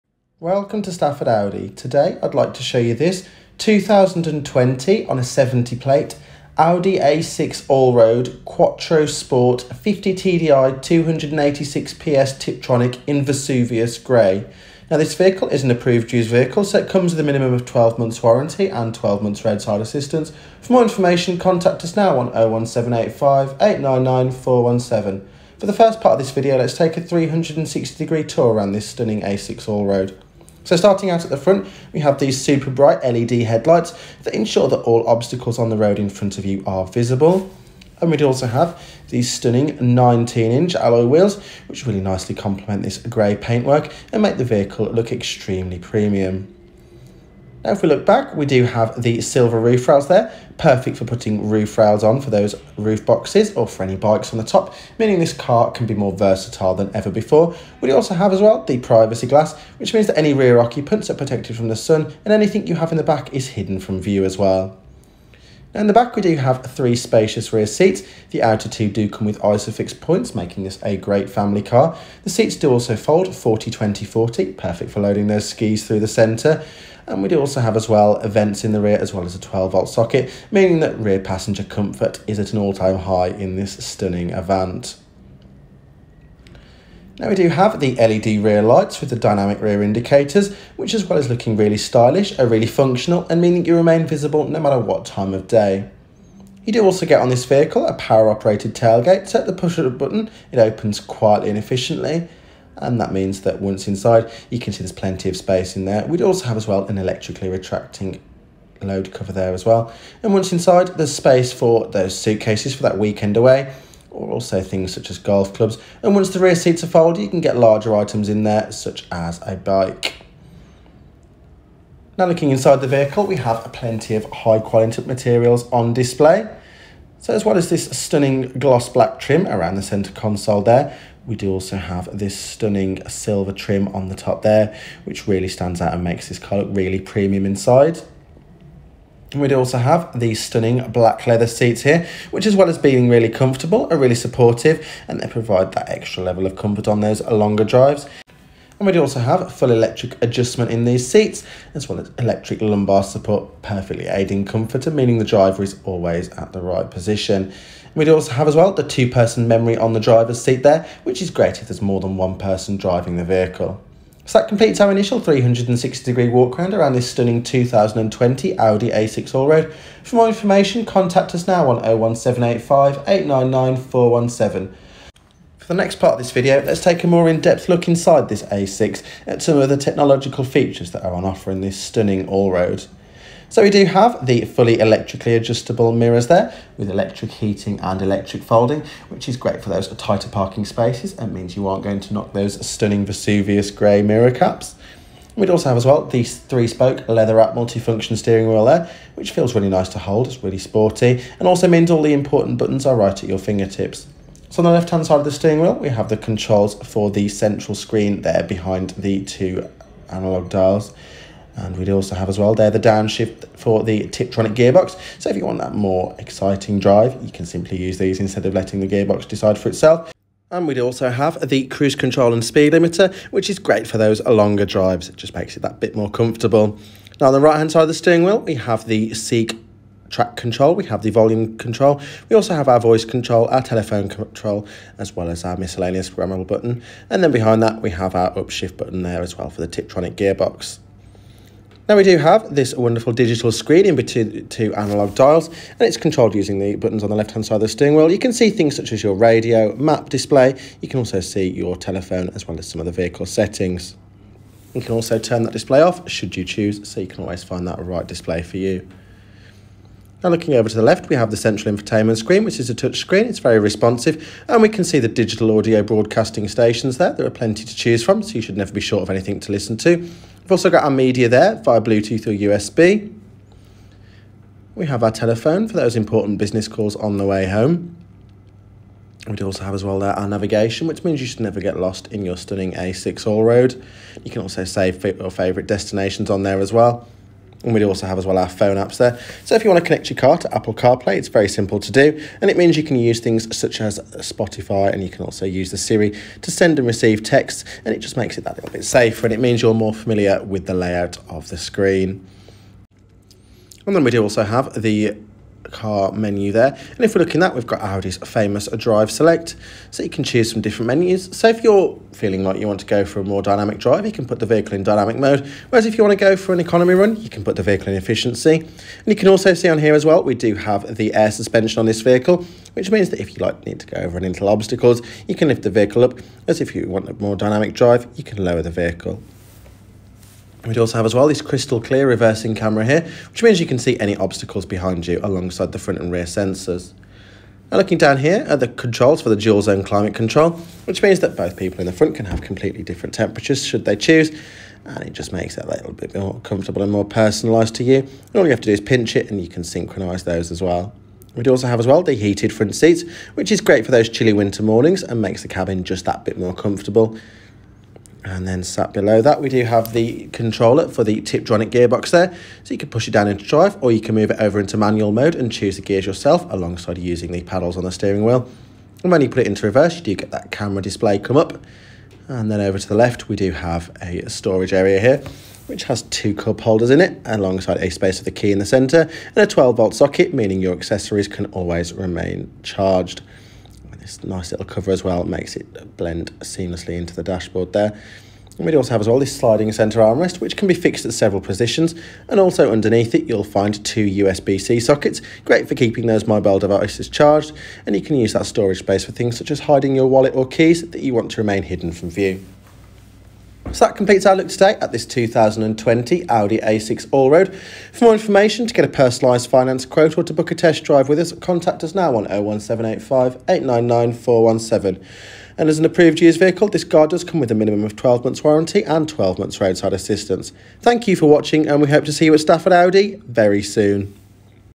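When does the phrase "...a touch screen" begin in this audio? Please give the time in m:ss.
4:22.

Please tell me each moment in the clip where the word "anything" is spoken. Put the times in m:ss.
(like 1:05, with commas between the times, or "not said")
1:02, 4:29.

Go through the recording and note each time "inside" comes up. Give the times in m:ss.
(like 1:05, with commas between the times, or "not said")
1:43, 1:50, 2:02, 2:17, 2:57.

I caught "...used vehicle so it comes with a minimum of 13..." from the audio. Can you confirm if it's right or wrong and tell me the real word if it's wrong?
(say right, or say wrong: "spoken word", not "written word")
wrong: "12", not "13".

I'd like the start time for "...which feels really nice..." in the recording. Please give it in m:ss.
3:19.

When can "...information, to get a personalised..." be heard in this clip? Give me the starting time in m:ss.
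6:48.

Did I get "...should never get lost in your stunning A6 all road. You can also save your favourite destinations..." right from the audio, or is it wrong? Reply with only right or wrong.
right.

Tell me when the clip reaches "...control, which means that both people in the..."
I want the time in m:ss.
5:40.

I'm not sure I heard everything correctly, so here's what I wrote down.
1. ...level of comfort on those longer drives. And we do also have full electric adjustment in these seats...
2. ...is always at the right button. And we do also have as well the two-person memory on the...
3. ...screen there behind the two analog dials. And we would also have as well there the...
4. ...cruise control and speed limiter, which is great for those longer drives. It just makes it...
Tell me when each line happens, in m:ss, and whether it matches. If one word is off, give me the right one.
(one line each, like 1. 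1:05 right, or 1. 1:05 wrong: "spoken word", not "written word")
1. 2:26 right
2. 2:35 wrong: "position", not "button"
3. 3:27 right
4. 3:41 right.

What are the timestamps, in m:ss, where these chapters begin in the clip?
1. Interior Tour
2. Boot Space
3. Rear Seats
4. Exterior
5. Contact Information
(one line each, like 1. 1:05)
1. 3:00
2. 1:41
3. 1:05
4. 0:20
5. 6:06.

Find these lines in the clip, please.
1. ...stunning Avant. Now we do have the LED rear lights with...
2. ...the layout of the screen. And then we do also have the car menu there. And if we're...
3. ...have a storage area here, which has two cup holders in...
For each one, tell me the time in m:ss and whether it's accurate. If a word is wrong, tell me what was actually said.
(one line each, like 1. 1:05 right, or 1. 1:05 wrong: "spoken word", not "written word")
1. 1:23 right
2. 5:00 right
3. 6:13 right.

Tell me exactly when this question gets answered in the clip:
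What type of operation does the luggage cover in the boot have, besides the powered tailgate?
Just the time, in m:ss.
1:46.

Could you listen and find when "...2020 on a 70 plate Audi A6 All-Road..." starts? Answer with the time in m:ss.
0:03.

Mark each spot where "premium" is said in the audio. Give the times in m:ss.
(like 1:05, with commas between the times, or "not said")
0:45, 2:16.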